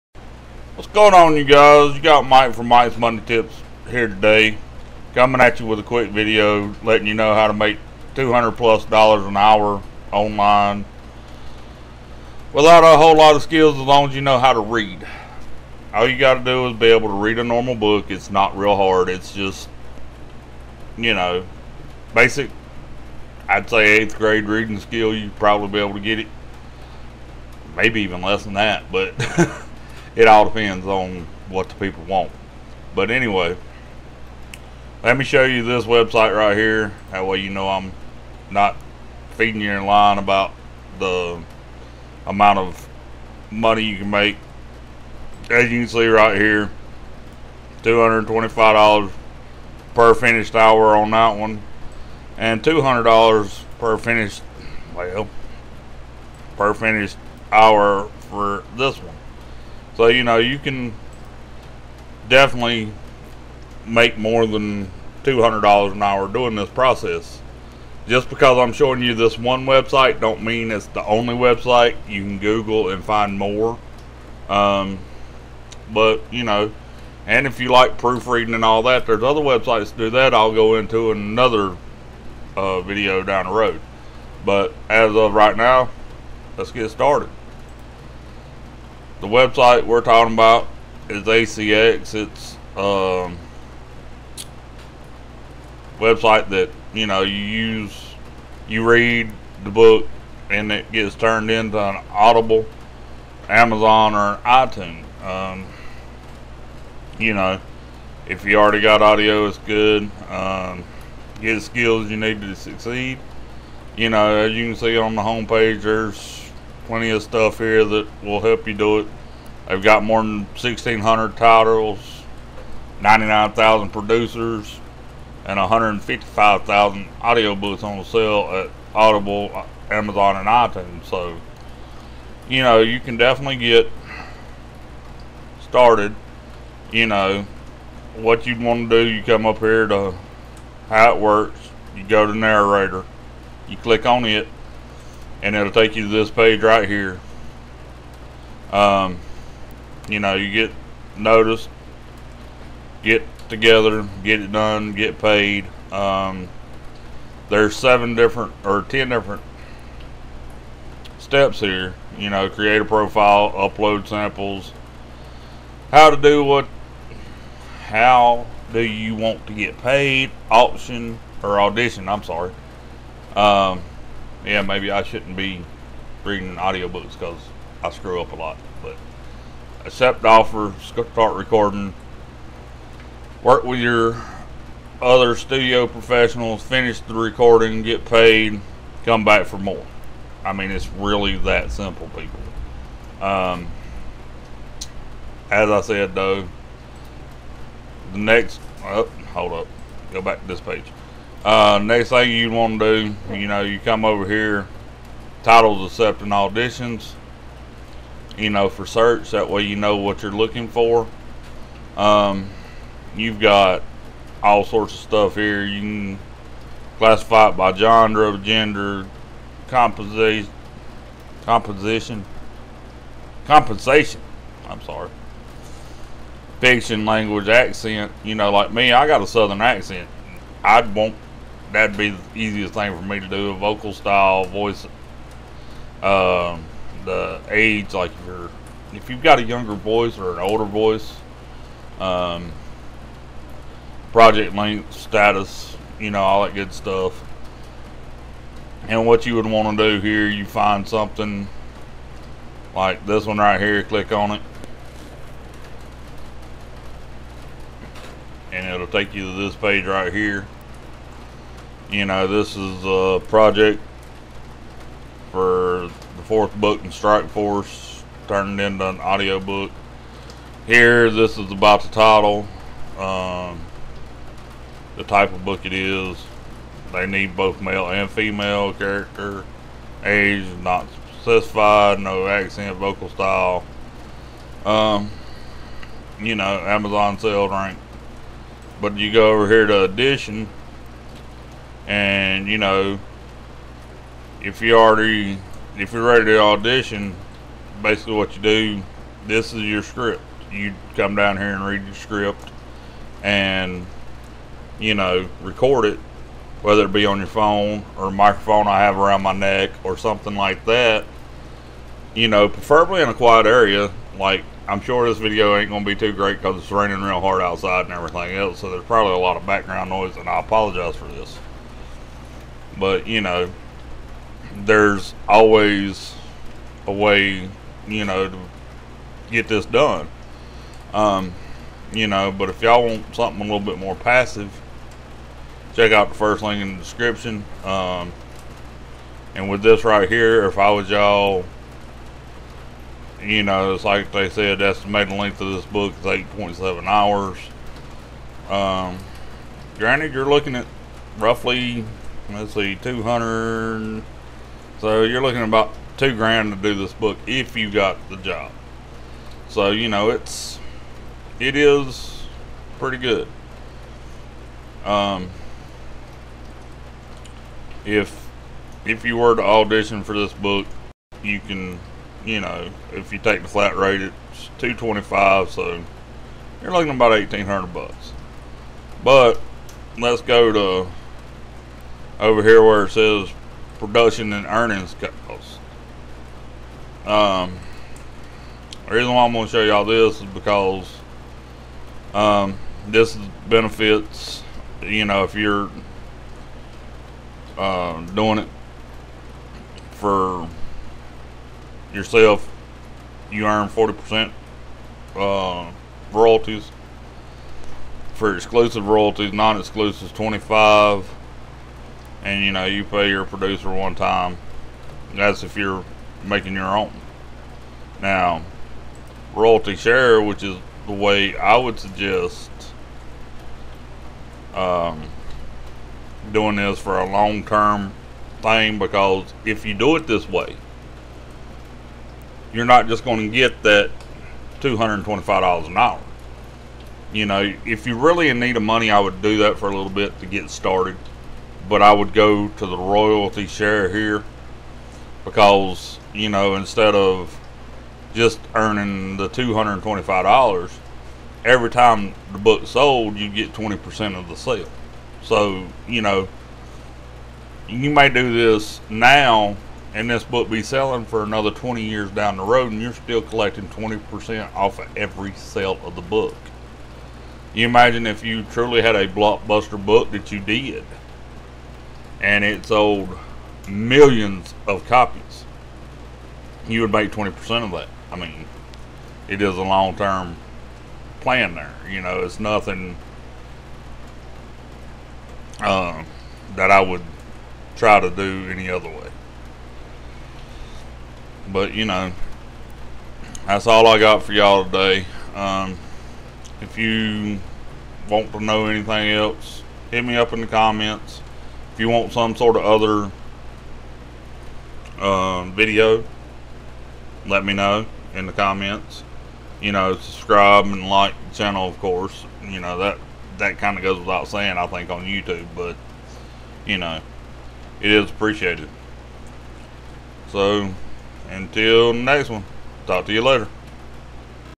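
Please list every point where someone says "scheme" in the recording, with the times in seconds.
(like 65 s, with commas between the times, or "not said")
not said.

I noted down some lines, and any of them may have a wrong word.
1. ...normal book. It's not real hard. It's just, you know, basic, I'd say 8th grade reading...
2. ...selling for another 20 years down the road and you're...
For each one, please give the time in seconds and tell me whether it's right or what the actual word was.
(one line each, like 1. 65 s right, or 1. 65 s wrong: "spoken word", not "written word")
1. 17 s right
2. 460 s right.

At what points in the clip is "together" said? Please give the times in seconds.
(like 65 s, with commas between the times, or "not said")
153 s.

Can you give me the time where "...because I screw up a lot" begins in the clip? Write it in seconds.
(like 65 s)
177 s.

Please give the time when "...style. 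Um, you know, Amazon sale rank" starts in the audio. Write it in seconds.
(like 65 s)
283 s.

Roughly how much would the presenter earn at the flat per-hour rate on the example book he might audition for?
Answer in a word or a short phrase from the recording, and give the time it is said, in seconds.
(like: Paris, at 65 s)
1800 bucks, at 377 s.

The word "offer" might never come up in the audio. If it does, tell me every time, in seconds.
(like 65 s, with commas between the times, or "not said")
180 s.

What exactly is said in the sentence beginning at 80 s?
I'll go into another uh, video down the road.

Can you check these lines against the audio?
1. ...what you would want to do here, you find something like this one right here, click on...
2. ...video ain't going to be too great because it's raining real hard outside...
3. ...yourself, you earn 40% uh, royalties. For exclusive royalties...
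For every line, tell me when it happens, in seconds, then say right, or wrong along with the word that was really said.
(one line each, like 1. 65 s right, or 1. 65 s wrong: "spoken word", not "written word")
1. 249 s right
2. 315 s right
3. 401 s right.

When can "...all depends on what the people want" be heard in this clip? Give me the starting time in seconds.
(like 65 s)
30 s.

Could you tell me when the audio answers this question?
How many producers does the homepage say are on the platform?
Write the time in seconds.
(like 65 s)
123 s.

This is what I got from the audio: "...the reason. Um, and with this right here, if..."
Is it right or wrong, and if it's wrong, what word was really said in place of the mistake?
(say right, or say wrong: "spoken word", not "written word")
wrong: "description", not "reason".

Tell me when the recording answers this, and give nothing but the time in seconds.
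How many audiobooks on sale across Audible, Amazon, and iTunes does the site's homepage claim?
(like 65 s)
125 s.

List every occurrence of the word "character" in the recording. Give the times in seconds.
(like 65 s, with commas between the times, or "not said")
278 s.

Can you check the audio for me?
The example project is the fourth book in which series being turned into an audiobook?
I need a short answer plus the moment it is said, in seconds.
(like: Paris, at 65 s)
Strike Force, at 266 s.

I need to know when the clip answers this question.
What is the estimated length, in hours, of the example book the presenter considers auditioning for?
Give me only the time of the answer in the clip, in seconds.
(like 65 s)
346 s.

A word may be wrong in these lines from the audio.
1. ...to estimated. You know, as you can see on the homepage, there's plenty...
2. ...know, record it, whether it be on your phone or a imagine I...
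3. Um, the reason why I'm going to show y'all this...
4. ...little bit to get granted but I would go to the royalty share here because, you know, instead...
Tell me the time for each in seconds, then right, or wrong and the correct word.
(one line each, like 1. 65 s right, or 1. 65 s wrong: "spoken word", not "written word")
1. 112 s wrong: "succeed", not "estimated"
2. 304 s wrong: "microphone", not "imagine"
3. 387 s right
4. 439 s wrong: "started", not "granted".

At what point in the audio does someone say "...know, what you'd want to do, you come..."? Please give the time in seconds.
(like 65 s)
137 s.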